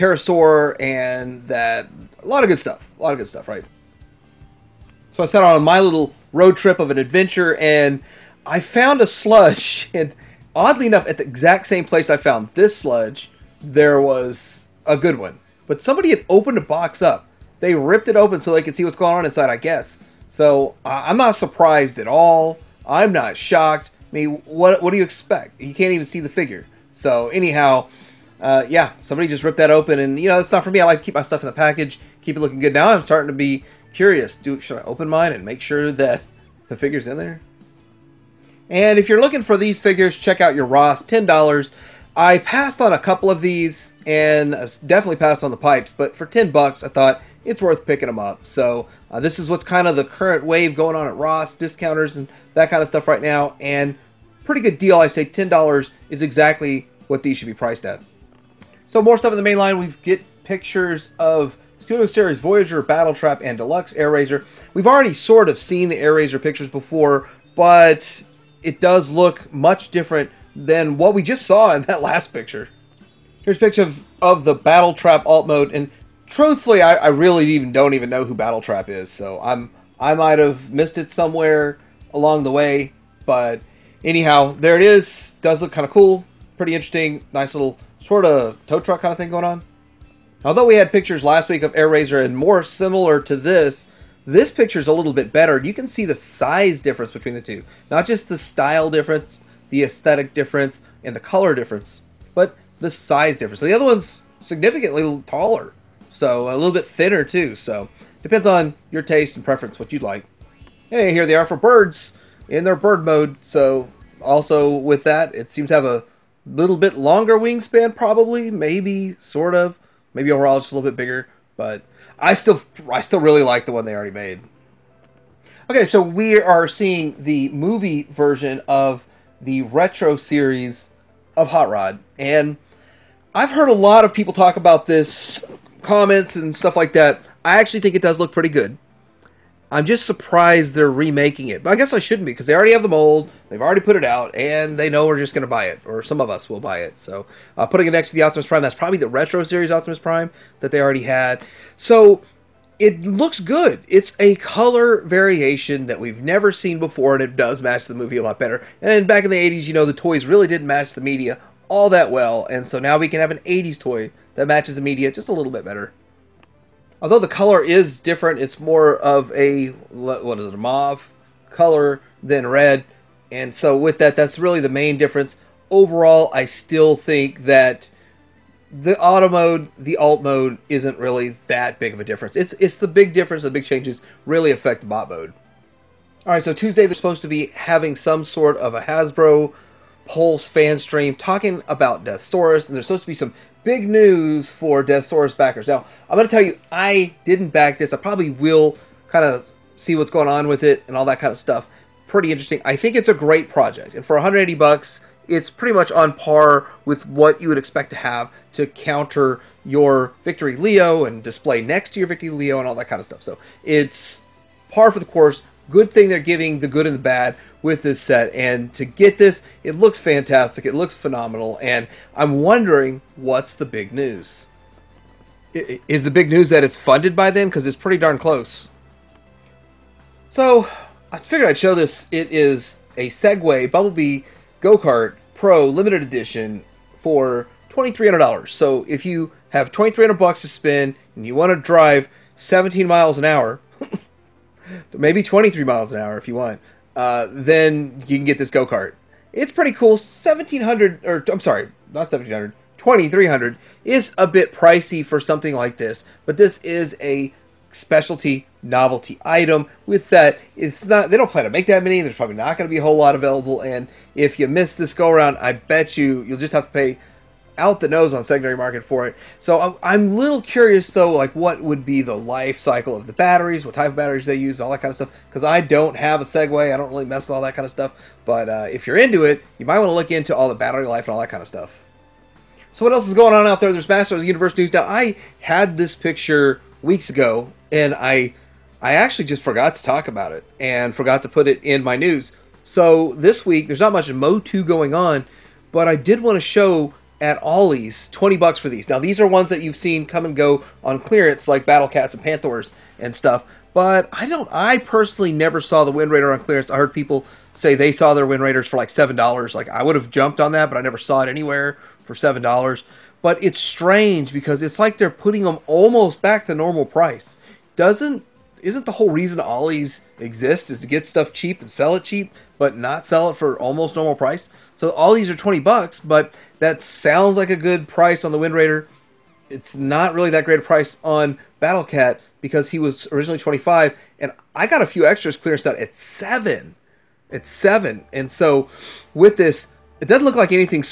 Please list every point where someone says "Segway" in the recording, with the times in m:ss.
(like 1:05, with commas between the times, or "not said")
3:53, 4:36.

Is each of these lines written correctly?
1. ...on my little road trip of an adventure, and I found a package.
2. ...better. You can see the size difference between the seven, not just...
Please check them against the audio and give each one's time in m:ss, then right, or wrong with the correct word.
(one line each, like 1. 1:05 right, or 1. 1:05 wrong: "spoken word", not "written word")
1. 0:05 wrong: "sludge", not "package"
2. 1:35 wrong: "two", not "seven".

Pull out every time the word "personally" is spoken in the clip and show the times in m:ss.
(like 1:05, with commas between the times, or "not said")
5:04.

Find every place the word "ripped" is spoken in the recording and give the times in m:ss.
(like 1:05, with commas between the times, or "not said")
0:17, 0:29.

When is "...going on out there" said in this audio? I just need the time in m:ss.
4:43.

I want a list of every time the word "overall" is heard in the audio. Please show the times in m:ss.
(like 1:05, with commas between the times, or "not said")
2:00, 2:55.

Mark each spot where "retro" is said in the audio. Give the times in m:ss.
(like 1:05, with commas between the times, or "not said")
2:09, 2:29.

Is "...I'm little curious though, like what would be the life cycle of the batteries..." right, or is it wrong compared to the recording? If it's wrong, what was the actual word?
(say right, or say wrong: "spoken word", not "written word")
right.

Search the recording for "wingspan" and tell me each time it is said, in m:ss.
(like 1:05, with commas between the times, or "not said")
1:57.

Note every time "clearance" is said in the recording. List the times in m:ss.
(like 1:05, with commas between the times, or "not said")
5:00, 5:06, 5:35.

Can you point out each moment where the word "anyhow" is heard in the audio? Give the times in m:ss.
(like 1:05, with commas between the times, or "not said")
0:27, 1:24.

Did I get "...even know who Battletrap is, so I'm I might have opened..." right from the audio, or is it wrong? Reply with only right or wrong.
wrong.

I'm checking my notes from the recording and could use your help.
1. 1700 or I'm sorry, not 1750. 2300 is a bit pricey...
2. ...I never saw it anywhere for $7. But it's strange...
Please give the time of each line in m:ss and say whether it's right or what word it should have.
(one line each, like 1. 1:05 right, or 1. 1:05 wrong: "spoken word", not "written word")
1. 4:09 wrong: "1700", not "1750"
2. 5:10 right.